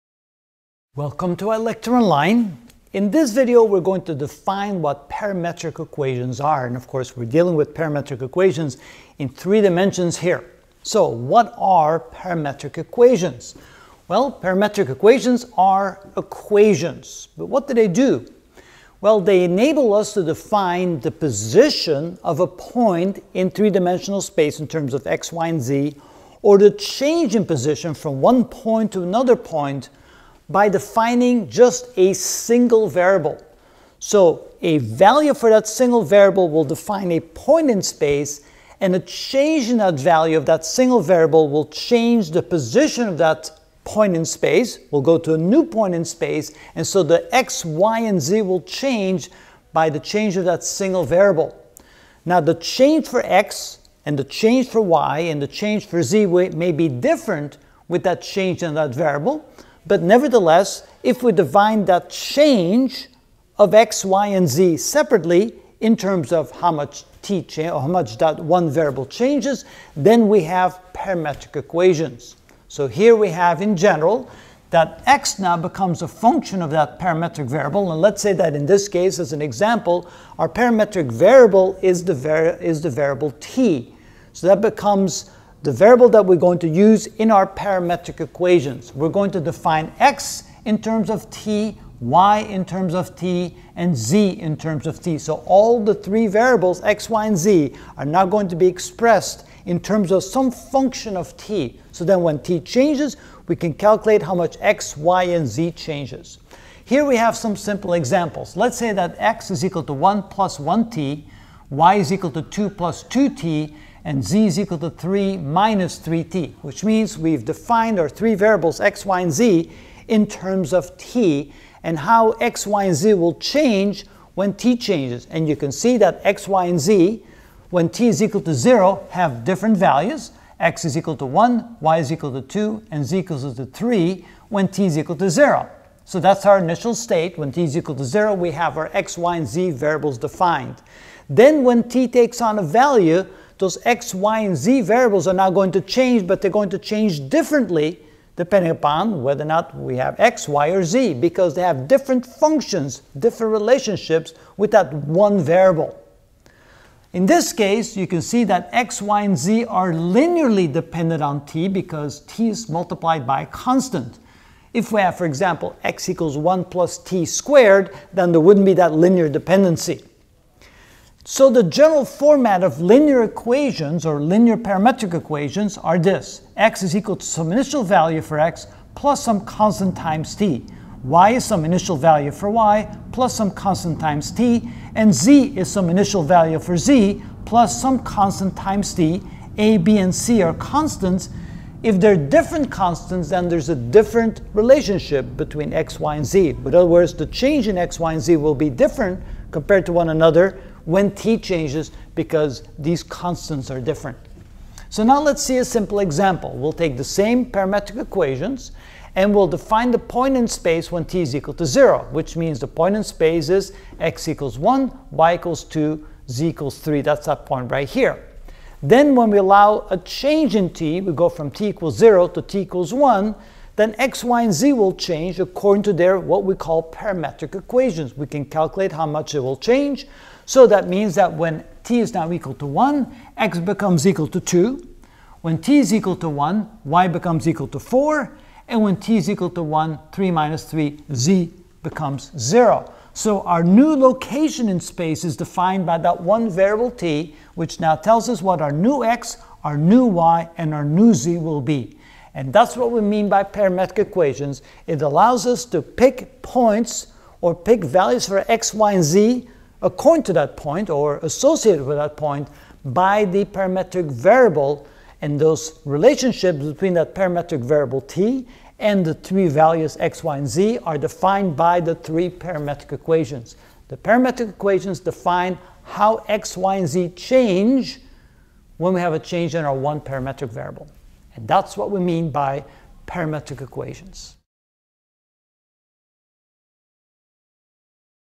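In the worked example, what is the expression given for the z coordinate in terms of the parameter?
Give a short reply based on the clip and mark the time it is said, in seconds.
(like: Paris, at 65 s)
3 - 3t, at 114 s.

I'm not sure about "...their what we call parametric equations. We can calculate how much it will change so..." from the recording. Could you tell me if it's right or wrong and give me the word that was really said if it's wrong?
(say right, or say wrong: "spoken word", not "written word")
right.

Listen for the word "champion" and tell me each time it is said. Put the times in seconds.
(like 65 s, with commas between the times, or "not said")
not said.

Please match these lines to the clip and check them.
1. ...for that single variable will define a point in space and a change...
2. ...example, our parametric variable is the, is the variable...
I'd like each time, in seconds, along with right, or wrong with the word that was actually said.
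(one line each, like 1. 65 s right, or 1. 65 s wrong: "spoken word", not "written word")
1. 35 s right
2. 79 s right.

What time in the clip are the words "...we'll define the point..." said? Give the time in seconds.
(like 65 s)
209 s.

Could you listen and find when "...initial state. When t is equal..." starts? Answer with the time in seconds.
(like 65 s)
136 s.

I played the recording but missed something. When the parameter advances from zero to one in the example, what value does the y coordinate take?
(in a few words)
4.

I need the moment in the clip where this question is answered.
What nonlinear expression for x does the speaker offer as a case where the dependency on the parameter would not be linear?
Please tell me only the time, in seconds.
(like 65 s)
166 s.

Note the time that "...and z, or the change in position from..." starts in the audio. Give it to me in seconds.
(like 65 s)
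25 s.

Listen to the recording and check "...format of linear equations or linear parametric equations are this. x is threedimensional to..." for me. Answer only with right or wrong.
wrong.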